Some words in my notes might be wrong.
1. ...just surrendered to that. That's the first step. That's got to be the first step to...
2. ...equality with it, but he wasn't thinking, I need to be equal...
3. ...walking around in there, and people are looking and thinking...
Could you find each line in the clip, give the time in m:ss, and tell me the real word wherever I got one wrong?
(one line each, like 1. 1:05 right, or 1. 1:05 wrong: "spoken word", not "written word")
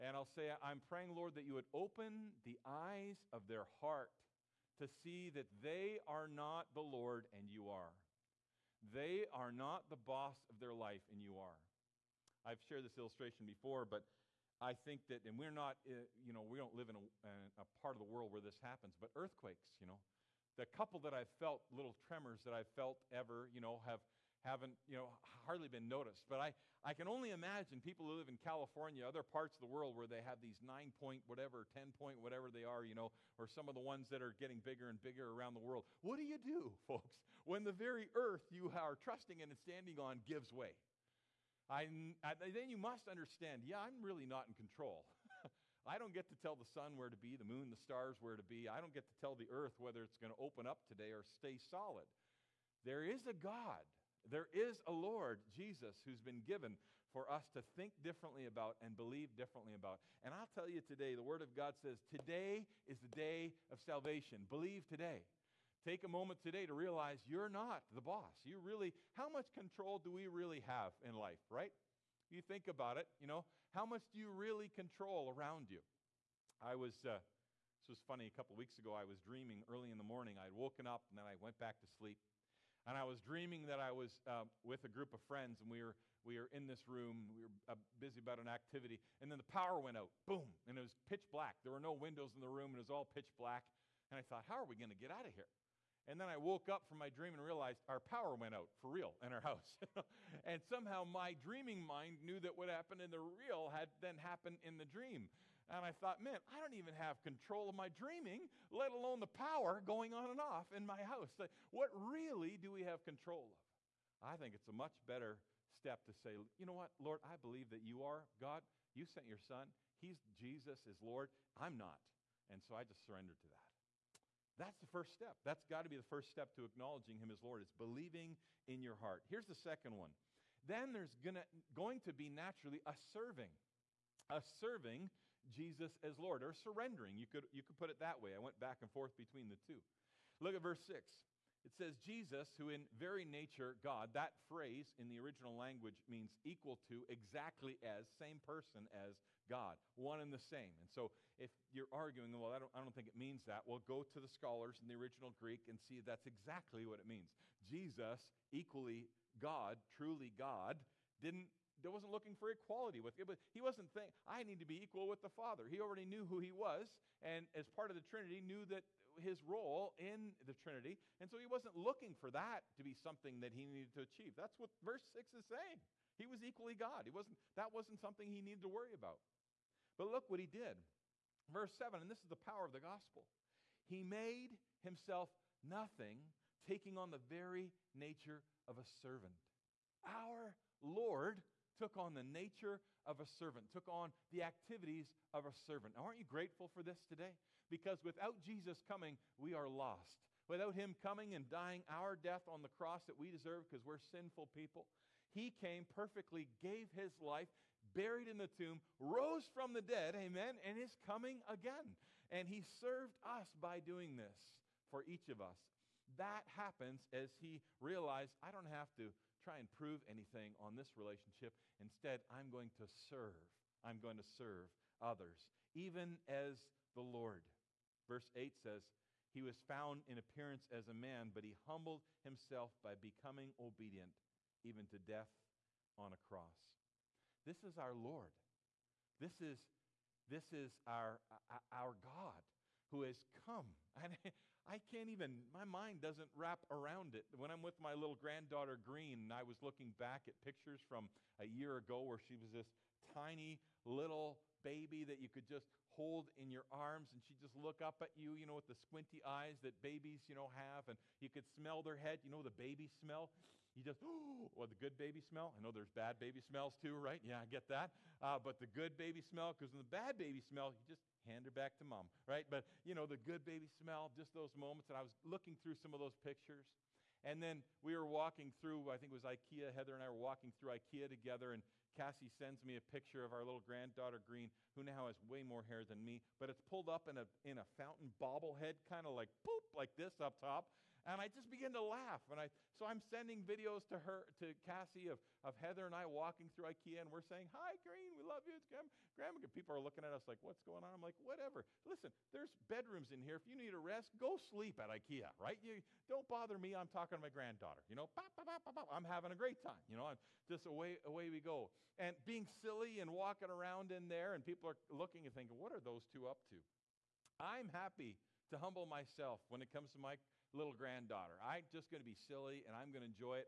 1. 2:02 right
2. 2:42 right
3. 5:13 right.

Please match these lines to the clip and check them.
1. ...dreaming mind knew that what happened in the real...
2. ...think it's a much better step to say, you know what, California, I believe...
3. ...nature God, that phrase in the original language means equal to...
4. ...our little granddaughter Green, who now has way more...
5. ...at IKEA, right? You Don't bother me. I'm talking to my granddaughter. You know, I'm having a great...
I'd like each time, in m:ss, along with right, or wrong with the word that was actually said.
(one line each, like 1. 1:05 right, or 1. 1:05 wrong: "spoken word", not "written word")
1. 1:41 right
2. 1:54 wrong: "Lord", not "California"
3. 2:23 right
4. 4:43 right
5. 5:04 right.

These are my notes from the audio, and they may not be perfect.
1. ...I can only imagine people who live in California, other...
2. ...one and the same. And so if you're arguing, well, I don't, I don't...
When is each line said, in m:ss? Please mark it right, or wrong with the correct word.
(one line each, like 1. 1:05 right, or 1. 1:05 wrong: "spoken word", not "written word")
1. 0:26 right
2. 2:29 right.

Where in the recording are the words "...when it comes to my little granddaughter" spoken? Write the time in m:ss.
5:19.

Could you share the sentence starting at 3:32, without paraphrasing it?
And he served us by doing this for each of us.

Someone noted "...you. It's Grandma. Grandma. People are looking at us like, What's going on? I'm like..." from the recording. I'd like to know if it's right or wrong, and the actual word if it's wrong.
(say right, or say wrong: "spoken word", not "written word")
right.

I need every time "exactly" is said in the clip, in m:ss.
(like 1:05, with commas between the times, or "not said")
2:27, 2:36.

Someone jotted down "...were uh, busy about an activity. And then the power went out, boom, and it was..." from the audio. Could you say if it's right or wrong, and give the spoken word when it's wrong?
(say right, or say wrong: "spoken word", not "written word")
right.